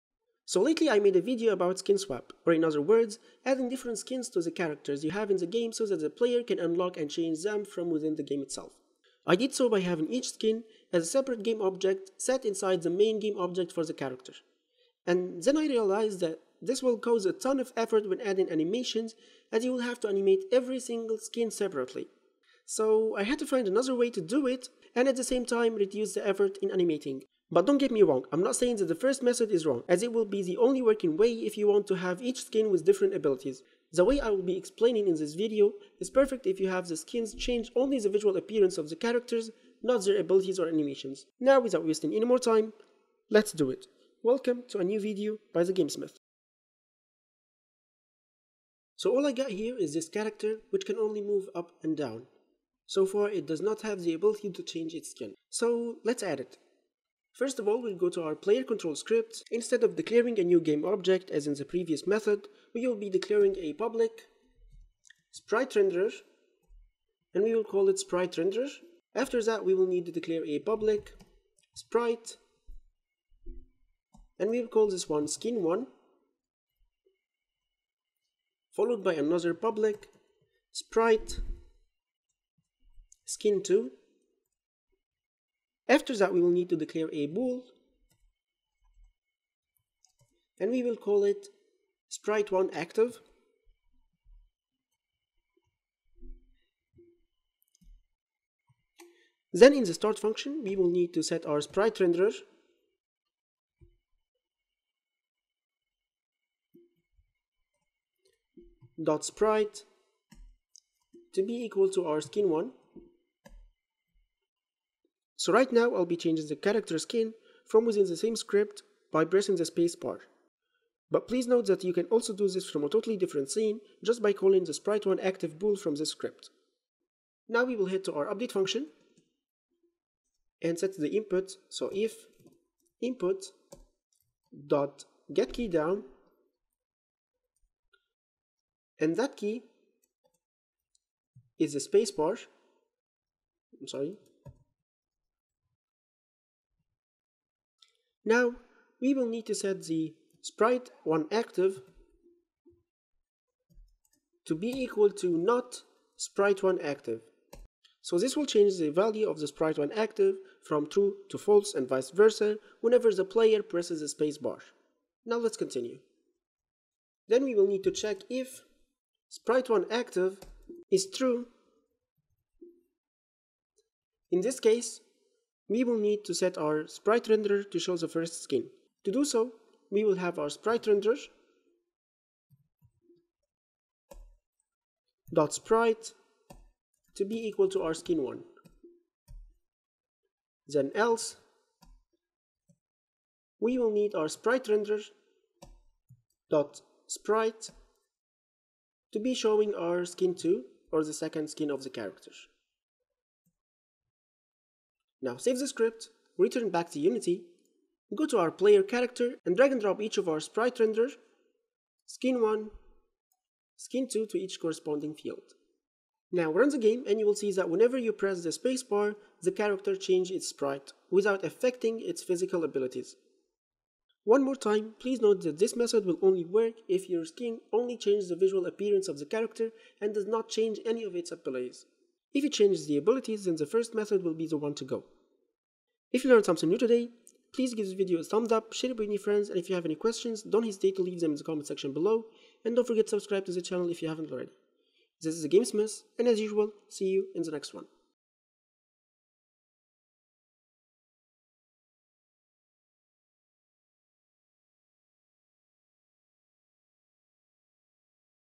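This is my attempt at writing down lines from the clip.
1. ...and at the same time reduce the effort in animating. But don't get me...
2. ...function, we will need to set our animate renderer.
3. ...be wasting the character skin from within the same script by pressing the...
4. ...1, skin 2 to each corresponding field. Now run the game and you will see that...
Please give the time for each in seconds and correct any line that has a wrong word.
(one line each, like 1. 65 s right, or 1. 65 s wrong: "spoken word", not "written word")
1. 24 s right
2. 100 s wrong: "sprite", not "animate"
3. 116 s wrong: "changing", not "wasting"
4. 212 s right.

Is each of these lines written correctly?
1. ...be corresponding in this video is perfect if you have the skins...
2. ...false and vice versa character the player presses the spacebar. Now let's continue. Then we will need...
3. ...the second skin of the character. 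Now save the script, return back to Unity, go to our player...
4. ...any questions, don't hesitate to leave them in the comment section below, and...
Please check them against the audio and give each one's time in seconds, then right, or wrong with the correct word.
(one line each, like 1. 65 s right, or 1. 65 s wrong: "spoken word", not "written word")
1. 34 s wrong: "explaining", not "corresponding"
2. 161 s wrong: "whenever", not "character"
3. 201 s right
4. 239 s right.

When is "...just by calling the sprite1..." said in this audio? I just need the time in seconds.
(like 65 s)
124 s.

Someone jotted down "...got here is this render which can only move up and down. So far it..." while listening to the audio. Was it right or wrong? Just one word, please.
wrong.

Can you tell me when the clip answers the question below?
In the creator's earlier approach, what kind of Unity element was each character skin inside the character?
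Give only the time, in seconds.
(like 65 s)
11 s.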